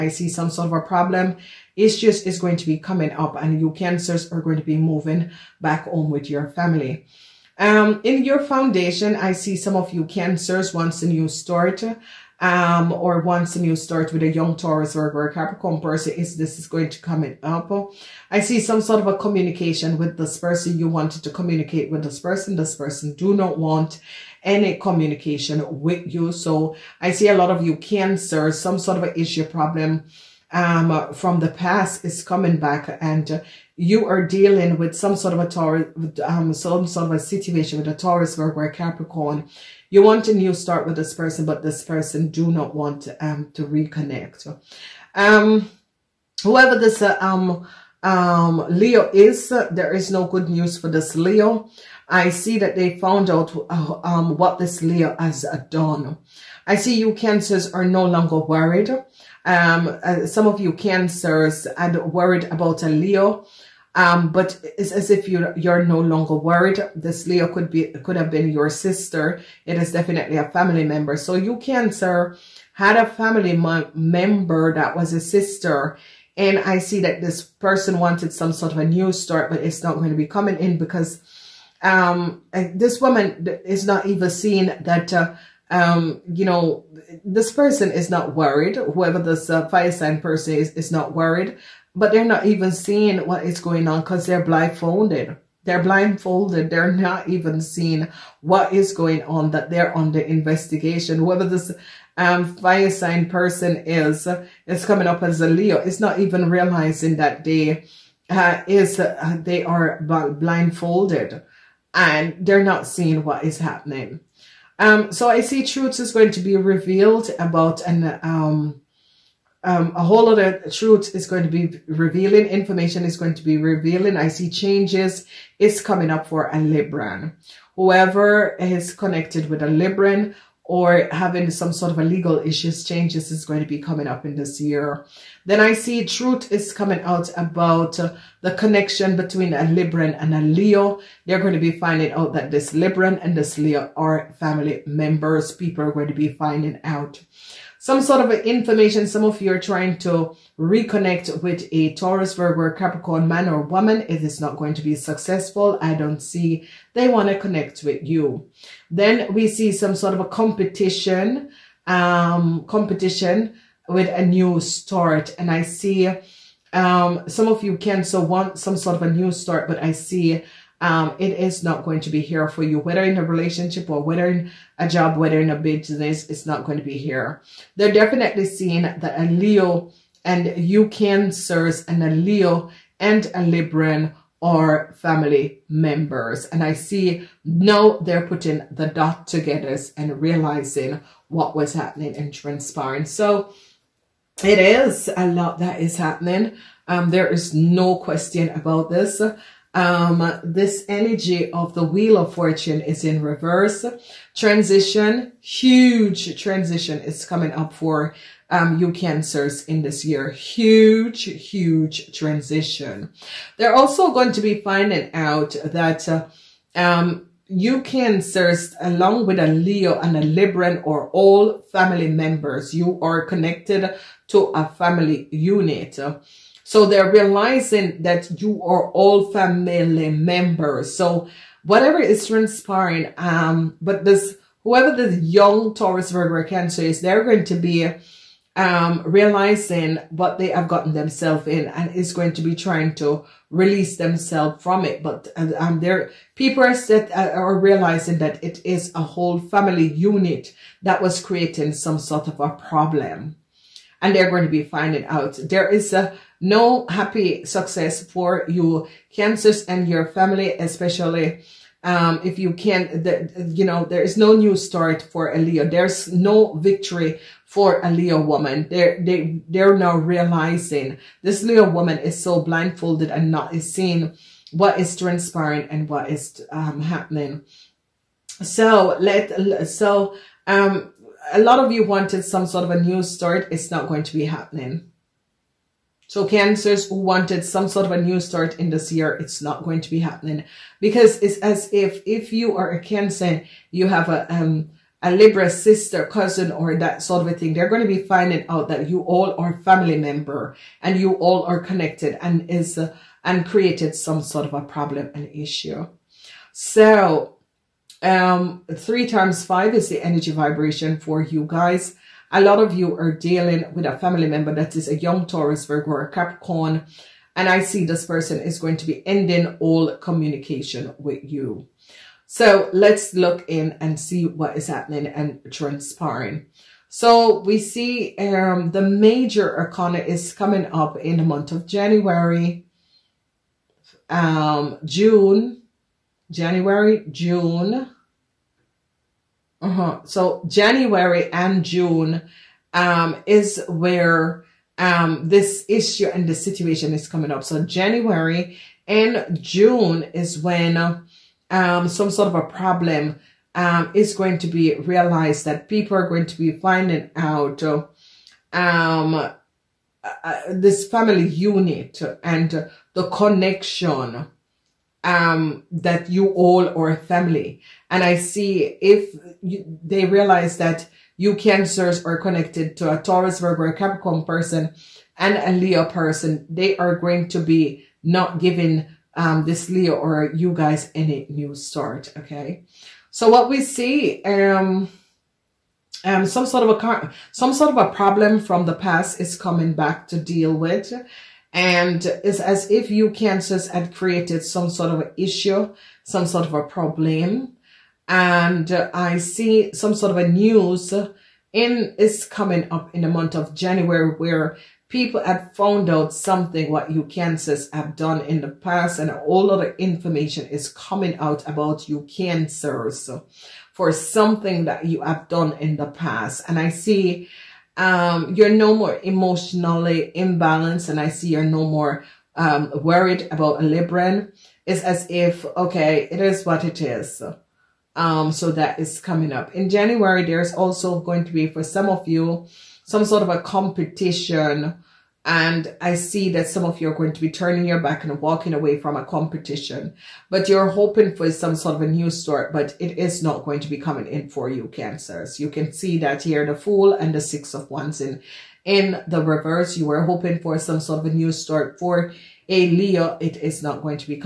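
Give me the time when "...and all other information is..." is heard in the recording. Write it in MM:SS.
06:48.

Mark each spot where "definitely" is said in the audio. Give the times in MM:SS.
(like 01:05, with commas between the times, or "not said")
01:09, 02:57.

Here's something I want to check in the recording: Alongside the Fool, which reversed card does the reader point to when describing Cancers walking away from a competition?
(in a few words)
Six of Wands.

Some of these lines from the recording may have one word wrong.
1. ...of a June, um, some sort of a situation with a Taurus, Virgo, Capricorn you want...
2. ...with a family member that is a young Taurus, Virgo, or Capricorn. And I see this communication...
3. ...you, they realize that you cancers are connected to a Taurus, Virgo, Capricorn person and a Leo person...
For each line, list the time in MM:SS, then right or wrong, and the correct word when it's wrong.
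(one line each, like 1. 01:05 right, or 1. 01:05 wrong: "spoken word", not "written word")
1. 00:35 wrong: "Taurus", not "June"
2. 05:13 wrong: "person", not "communication"
3. 06:09 right.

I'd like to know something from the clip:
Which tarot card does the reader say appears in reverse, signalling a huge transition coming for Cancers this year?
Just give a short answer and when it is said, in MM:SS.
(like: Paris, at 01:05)
Wheel of Fortune, at 03:21.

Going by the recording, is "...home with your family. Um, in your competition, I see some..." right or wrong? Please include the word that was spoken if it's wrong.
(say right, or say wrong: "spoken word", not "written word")
wrong: "foundation", not "competition".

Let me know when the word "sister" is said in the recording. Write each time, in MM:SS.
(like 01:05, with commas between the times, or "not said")
01:08, 01:15, 04:55.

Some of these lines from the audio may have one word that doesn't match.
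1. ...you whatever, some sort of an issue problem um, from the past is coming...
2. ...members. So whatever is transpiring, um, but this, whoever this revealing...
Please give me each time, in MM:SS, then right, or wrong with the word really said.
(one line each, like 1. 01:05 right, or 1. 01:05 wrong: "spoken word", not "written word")
1. 00:27 wrong: "cancer", not "whatever"
2. 03:50 wrong: "young", not "revealing".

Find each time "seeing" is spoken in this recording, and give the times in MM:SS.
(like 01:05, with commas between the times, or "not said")
01:24, 01:32, 01:37, 01:52, 02:58, 04:33.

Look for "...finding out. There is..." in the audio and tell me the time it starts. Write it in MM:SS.
04:14.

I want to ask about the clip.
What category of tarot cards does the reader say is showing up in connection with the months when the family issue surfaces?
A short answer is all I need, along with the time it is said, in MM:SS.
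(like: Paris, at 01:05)
major arcana, at 05:28.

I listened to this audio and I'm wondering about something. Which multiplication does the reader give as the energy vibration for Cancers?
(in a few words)
3 times 5.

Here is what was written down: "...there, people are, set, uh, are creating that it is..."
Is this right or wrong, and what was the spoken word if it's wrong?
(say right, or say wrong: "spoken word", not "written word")
wrong: "realizing", not "creating".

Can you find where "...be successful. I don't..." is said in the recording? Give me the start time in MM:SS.
02:34.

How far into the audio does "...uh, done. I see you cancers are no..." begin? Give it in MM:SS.
00:55.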